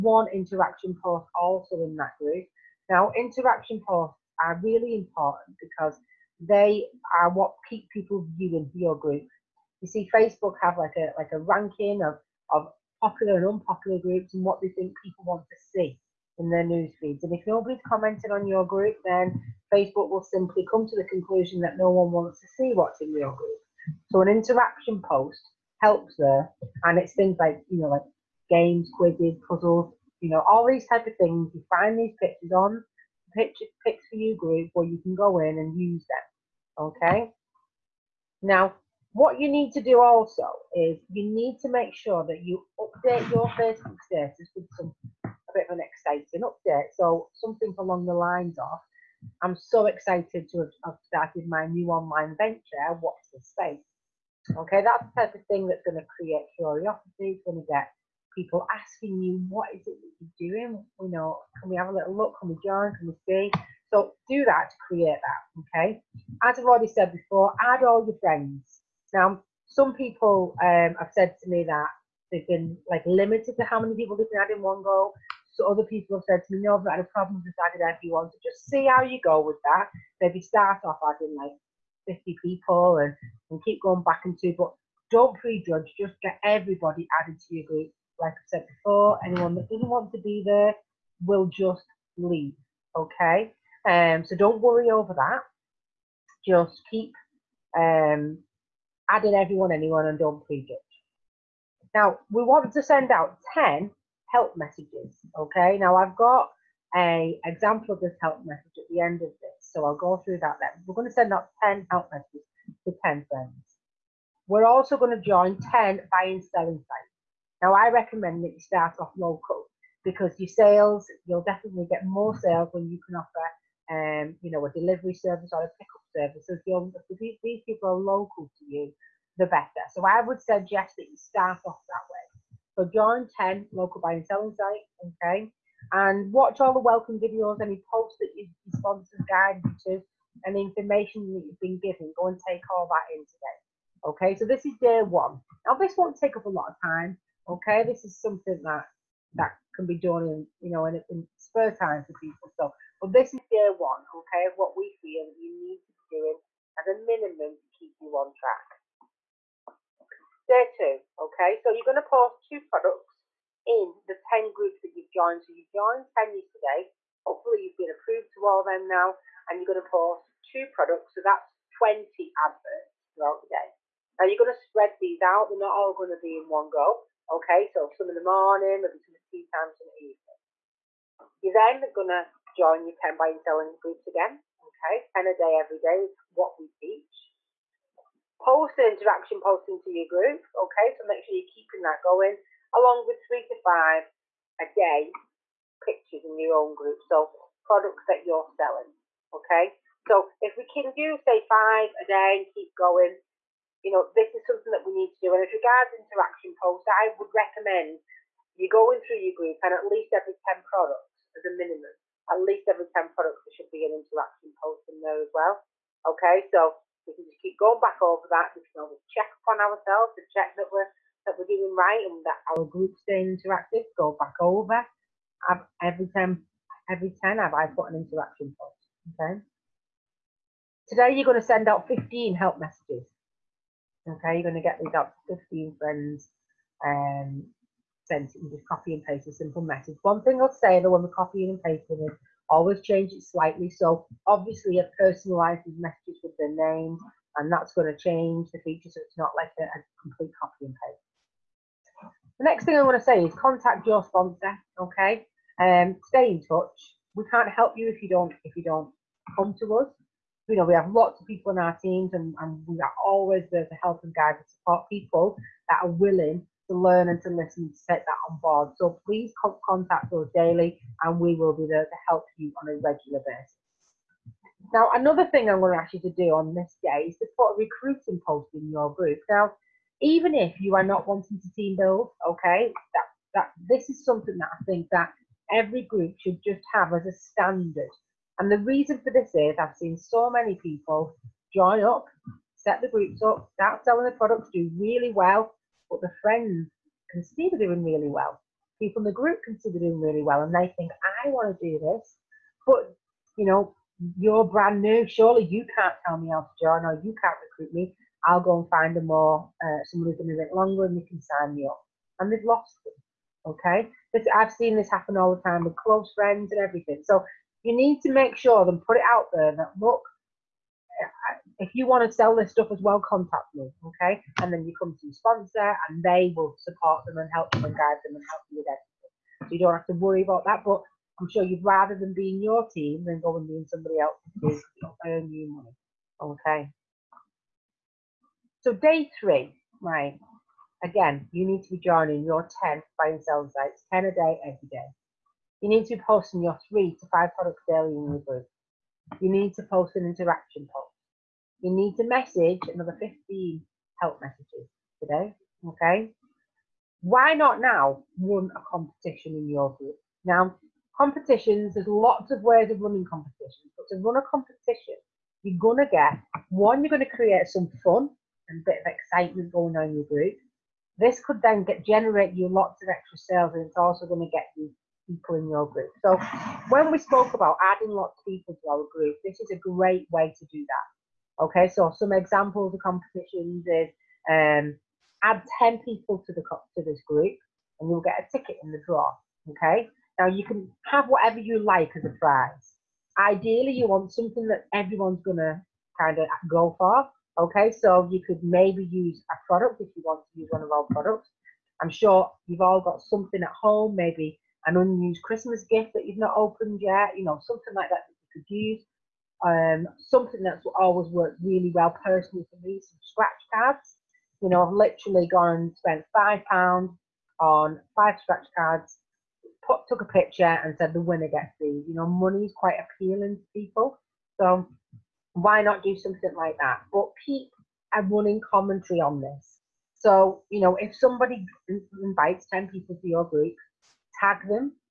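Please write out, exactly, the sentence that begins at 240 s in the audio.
One thing I'll say though when we're copying and pasting is always change it slightly.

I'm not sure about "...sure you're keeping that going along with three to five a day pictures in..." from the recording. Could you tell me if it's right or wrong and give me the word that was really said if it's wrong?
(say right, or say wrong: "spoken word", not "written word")
right.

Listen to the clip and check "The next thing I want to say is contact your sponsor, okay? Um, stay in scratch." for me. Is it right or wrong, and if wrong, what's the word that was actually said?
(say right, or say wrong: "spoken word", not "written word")
wrong: "touch", not "scratch".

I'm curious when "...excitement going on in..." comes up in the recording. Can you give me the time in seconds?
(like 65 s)
368 s.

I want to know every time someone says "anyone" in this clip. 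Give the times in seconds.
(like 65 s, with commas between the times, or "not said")
89 s, 99 s.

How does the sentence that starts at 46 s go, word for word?
So something along the lines of, I'm so excited to have, have started my new online venture.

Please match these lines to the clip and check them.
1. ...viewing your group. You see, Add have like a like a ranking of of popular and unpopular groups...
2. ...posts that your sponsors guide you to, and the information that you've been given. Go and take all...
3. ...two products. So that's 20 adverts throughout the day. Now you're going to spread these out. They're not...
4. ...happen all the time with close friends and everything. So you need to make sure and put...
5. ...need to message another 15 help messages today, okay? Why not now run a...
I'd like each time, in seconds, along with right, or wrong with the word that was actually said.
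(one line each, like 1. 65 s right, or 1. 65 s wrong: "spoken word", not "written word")
1. 8 s wrong: "Facebook", not "Add"
2. 137 s right
3. 170 s right
4. 314 s right
5. 351 s right.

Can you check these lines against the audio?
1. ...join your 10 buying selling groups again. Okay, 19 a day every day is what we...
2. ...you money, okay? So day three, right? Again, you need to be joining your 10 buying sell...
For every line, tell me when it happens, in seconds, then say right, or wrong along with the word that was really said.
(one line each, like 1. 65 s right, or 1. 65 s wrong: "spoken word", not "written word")
1. 182 s wrong: "10", not "19"
2. 335 s right.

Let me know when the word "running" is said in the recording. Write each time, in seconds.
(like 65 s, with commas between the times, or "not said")
362 s, 428 s.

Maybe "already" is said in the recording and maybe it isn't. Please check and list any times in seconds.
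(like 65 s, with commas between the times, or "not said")
66 s.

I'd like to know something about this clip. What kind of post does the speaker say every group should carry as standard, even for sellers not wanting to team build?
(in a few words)
Recruiting post.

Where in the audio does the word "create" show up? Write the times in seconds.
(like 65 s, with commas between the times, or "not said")
56 s, 64 s, 367 s.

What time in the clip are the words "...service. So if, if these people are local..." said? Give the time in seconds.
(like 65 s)
126 s.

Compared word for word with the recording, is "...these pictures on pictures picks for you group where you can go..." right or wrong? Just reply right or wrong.
right.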